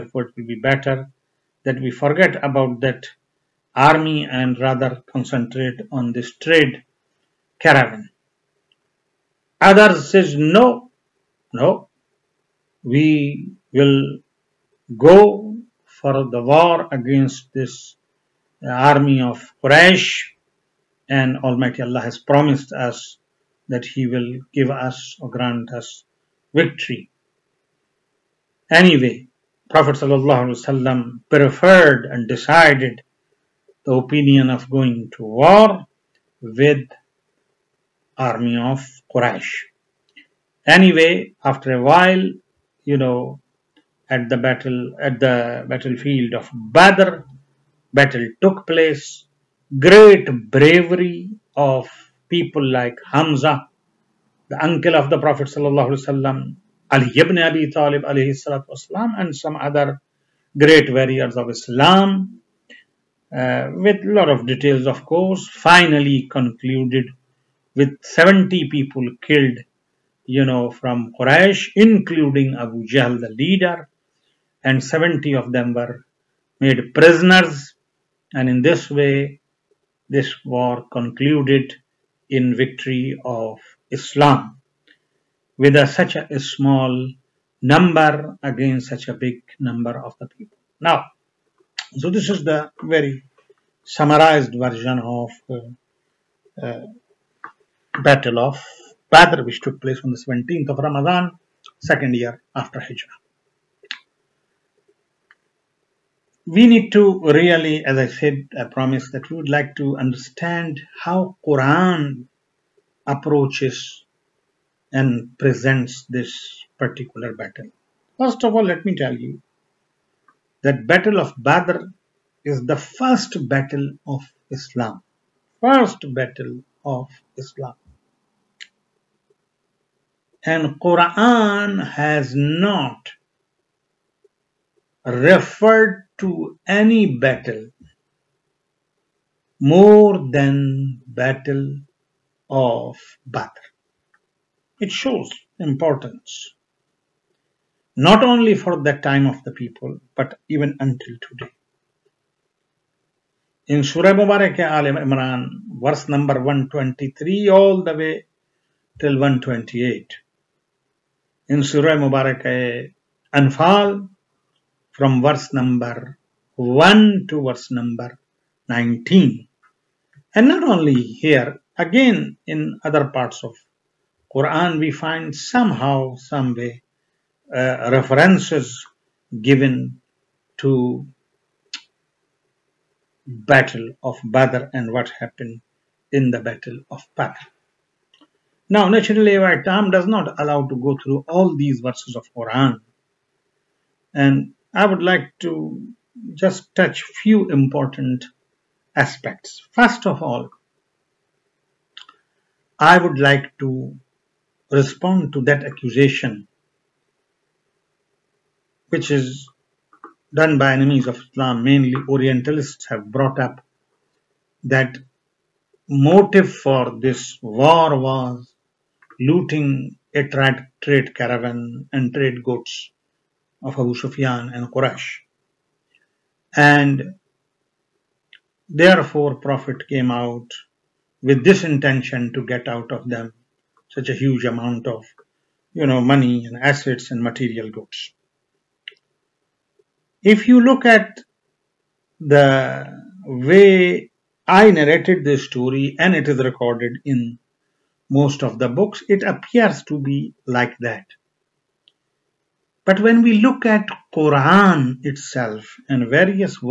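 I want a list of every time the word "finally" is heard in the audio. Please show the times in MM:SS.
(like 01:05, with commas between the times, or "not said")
01:05.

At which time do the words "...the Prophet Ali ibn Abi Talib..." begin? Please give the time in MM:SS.
00:55.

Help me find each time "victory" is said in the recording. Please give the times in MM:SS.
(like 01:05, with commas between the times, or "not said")
00:26, 01:22.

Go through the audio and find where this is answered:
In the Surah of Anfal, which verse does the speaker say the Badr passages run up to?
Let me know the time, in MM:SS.
02:47.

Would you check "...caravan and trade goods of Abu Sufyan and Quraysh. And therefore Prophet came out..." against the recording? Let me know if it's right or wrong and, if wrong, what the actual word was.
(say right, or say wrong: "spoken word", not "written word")
right.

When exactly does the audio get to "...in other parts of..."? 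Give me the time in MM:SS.
02:52.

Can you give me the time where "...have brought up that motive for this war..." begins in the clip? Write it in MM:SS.
03:32.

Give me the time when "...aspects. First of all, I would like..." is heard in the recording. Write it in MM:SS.
03:18.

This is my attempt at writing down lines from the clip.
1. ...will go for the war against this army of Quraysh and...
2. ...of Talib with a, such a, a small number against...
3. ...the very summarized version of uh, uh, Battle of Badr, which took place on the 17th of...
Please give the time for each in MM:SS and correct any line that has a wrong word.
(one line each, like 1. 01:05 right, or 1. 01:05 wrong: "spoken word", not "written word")
1. 00:13 right
2. 01:23 wrong: "Islam", not "Talib"
3. 01:32 right.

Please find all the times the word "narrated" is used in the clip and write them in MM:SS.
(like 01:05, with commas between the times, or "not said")
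04:04.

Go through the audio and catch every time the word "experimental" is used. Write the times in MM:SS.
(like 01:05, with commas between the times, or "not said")
not said.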